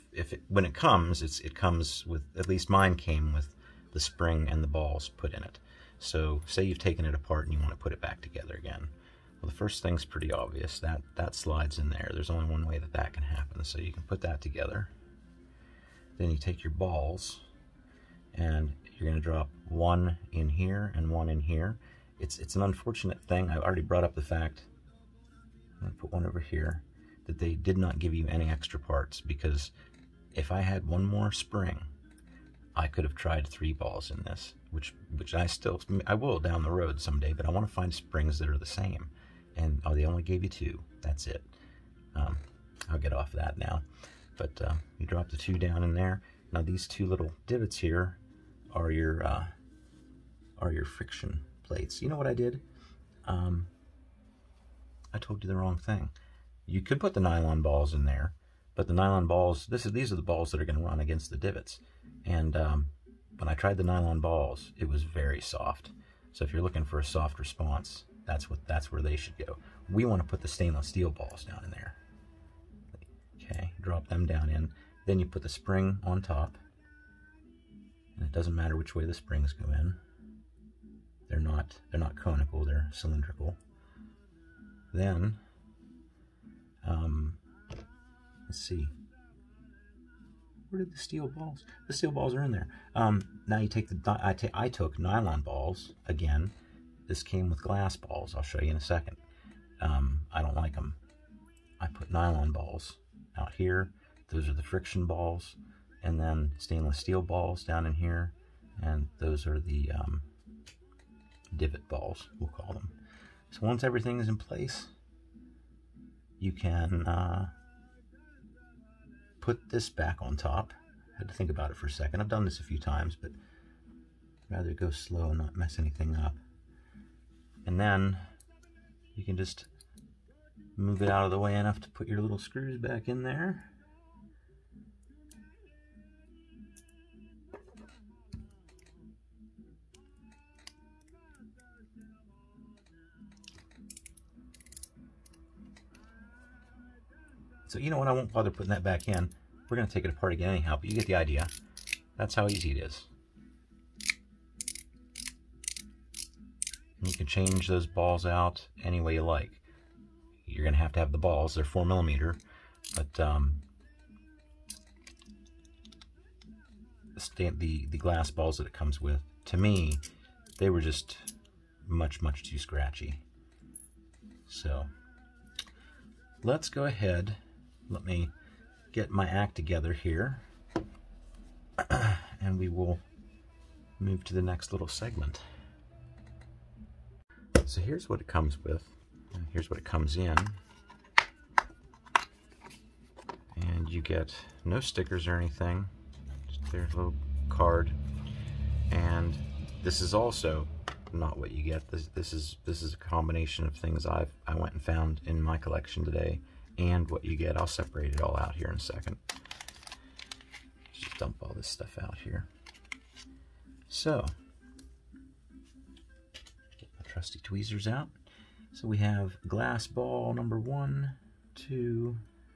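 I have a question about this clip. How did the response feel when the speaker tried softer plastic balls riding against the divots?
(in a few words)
very soft.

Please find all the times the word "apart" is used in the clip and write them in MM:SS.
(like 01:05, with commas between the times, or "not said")
00:07, 02:30.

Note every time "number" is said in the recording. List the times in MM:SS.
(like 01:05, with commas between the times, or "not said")
03:40.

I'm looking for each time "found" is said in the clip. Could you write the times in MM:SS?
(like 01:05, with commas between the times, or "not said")
03:24.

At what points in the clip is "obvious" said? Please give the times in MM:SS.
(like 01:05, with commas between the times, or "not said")
00:10.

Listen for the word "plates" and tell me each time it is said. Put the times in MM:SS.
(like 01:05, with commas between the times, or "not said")
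00:51.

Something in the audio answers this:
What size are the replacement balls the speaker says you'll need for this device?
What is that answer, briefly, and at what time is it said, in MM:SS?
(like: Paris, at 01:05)
4 millimeter, at 02:41.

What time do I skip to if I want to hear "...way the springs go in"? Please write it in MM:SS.
01:18.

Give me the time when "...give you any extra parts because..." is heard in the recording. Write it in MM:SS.
00:27.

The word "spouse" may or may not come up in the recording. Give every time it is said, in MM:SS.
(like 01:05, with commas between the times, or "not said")
not said.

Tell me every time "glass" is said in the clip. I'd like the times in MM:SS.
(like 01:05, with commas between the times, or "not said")
01:37, 02:47, 03:39.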